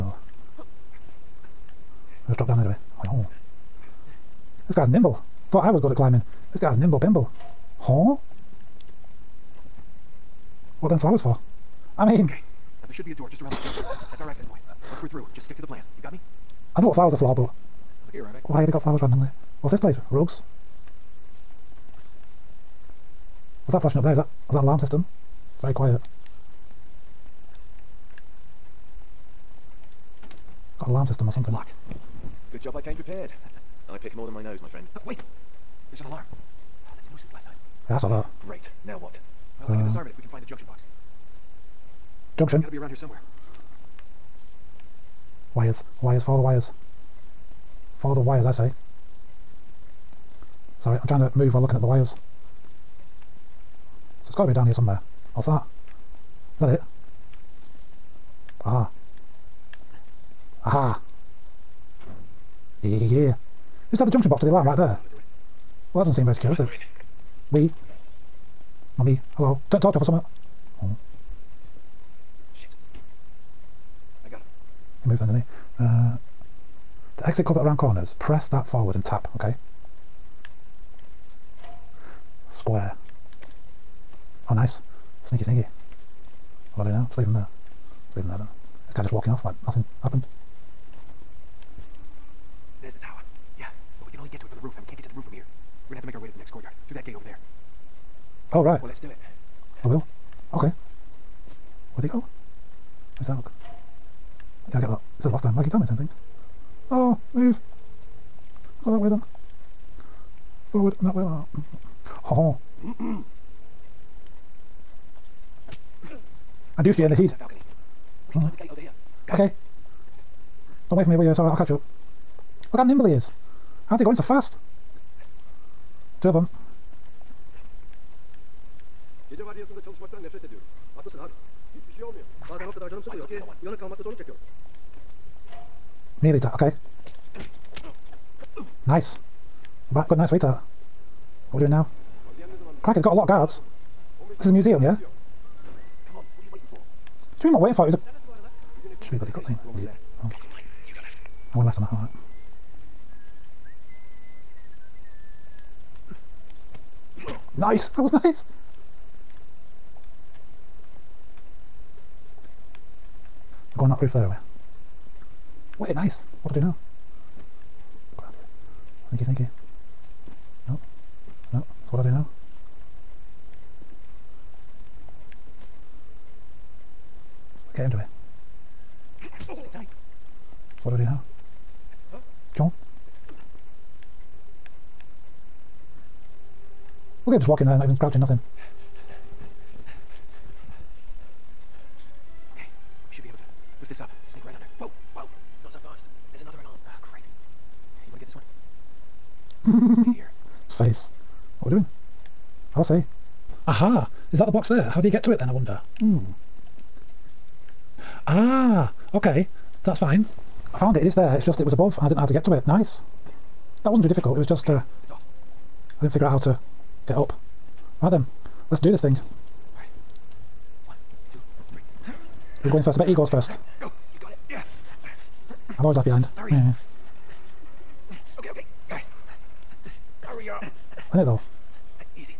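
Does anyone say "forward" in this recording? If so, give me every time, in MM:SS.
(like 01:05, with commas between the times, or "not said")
01:18, 01:50.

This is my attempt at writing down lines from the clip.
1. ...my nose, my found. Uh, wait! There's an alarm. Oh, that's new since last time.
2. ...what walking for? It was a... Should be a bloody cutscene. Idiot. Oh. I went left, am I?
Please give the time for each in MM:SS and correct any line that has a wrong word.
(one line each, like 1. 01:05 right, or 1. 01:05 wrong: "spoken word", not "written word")
1. 00:34 wrong: "friend", not "found"
2. 02:27 wrong: "waiting", not "walking".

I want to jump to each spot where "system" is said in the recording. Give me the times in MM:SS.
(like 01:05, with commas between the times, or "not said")
00:24, 00:31.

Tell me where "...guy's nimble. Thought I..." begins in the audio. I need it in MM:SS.
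00:04.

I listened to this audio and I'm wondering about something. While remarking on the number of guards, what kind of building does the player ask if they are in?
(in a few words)
a museum.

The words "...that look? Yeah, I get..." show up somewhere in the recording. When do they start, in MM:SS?
01:43.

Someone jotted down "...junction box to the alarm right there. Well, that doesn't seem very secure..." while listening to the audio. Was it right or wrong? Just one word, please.
right.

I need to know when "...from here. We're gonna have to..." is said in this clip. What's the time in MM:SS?
01:35.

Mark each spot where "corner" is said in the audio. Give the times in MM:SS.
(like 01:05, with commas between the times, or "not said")
00:13, 01:17.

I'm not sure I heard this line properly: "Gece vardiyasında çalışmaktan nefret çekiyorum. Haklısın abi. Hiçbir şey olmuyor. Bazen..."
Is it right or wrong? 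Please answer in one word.
wrong.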